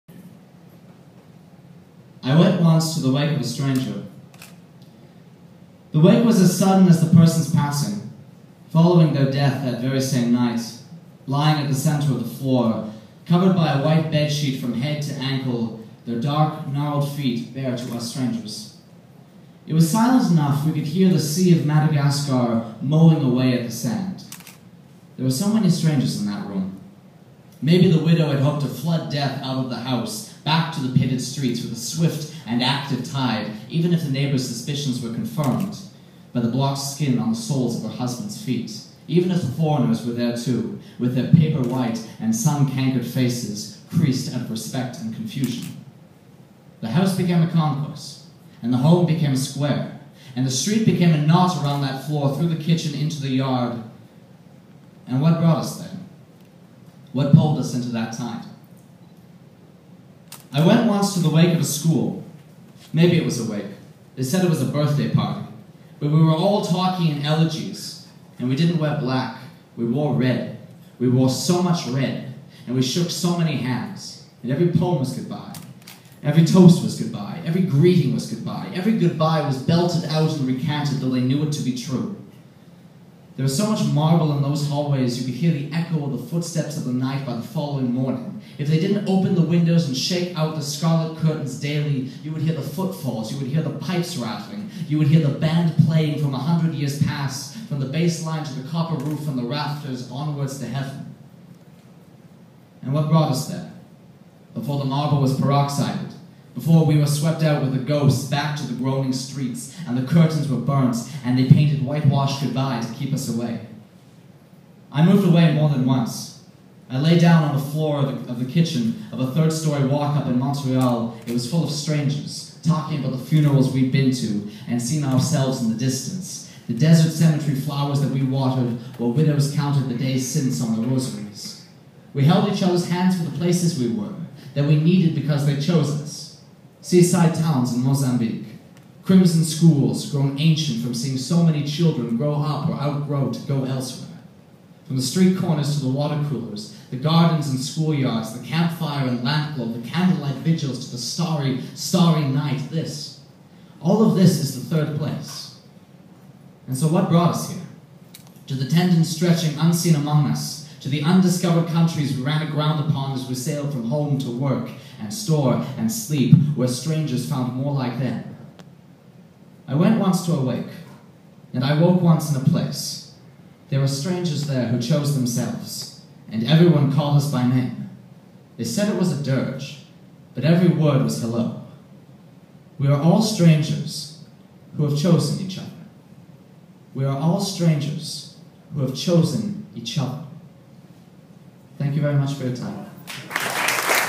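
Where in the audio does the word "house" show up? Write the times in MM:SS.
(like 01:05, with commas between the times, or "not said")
00:29, 00:46.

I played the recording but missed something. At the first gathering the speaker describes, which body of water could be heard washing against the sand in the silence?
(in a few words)
the sea of Madagascar.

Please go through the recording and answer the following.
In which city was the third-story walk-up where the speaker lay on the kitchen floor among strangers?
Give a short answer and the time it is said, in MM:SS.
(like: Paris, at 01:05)
Montreal, at 02:00.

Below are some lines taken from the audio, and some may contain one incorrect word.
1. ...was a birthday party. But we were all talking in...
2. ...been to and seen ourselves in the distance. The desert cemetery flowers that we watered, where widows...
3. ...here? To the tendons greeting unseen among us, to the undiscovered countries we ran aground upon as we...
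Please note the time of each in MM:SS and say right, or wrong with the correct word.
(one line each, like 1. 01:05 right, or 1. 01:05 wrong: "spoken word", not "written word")
1. 01:04 right
2. 02:03 right
3. 02:37 wrong: "stretching", not "greeting".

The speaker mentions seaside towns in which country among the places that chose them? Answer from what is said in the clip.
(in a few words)
Mozambique.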